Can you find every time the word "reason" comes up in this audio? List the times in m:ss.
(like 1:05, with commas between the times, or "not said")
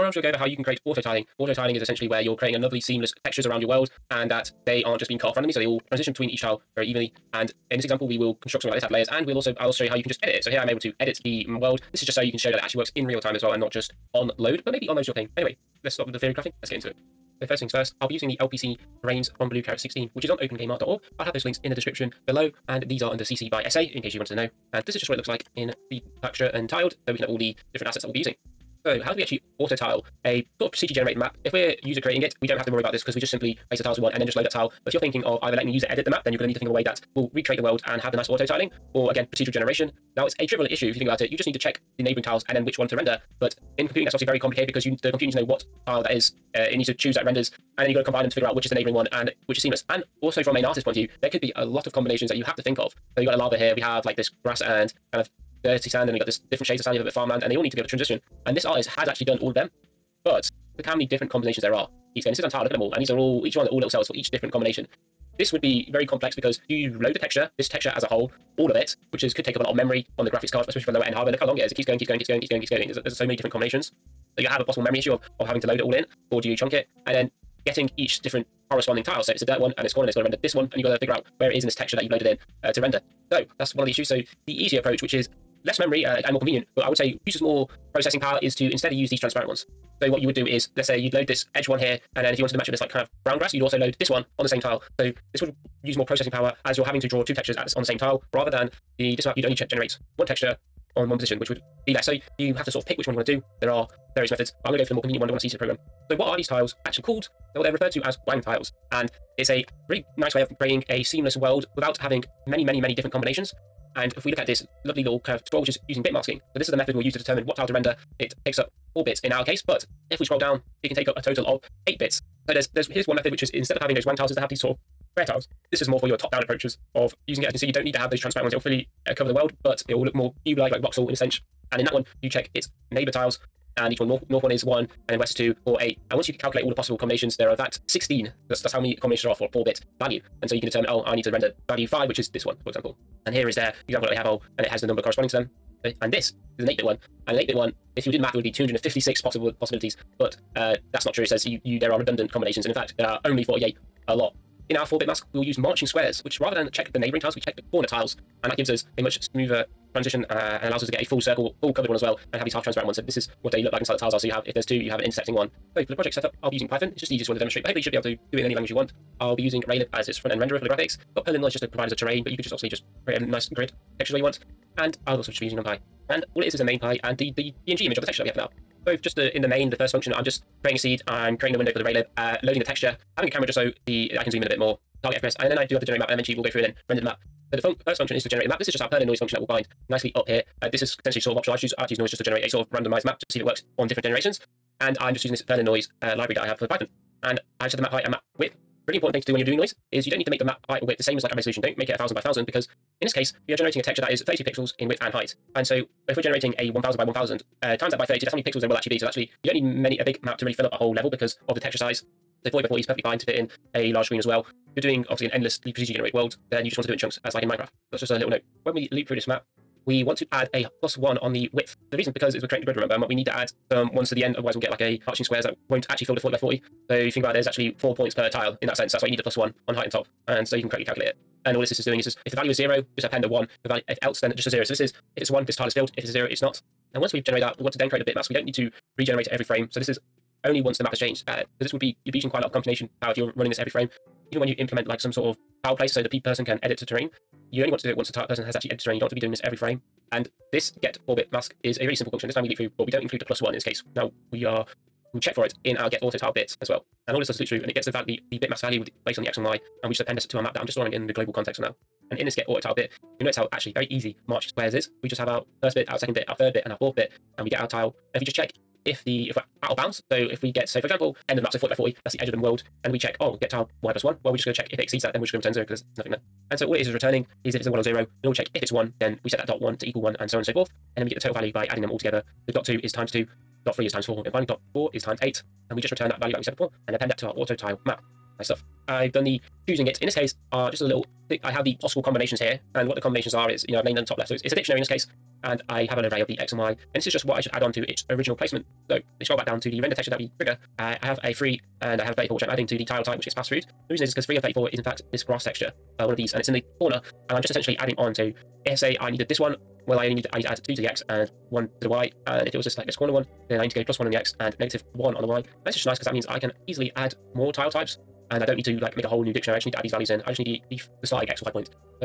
3:41, 5:03.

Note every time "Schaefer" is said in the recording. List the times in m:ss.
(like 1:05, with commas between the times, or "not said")
not said.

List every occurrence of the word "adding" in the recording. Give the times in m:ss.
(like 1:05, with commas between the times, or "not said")
4:41, 5:02, 5:07.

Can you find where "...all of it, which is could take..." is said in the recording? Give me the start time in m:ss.
1:08.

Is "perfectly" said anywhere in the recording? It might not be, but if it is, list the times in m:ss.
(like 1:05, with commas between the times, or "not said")
3:32.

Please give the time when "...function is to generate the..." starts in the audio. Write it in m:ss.
3:07.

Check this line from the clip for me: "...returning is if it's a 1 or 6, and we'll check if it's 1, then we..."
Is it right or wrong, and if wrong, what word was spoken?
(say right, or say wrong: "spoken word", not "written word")
wrong: "0", not "6".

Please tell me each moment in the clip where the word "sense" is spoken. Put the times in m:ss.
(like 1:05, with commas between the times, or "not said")
2:11, 3:48.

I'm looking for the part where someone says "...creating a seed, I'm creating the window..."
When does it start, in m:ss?
3:00.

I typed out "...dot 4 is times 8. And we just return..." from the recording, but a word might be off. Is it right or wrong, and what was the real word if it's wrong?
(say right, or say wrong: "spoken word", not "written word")
right.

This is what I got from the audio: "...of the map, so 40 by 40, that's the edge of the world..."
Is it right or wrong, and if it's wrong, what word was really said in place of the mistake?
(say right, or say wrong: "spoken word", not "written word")
right.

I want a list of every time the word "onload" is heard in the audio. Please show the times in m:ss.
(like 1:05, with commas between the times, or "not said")
0:14.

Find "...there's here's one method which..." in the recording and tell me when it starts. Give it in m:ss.
2:02.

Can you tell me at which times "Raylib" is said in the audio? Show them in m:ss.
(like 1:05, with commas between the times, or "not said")
2:49, 3:01.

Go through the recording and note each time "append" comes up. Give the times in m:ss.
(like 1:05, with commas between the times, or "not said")
3:53, 4:19, 4:46.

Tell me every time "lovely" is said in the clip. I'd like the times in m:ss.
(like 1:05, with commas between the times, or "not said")
0:02, 1:54.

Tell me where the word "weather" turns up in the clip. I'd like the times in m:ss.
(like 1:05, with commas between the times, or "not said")
not said.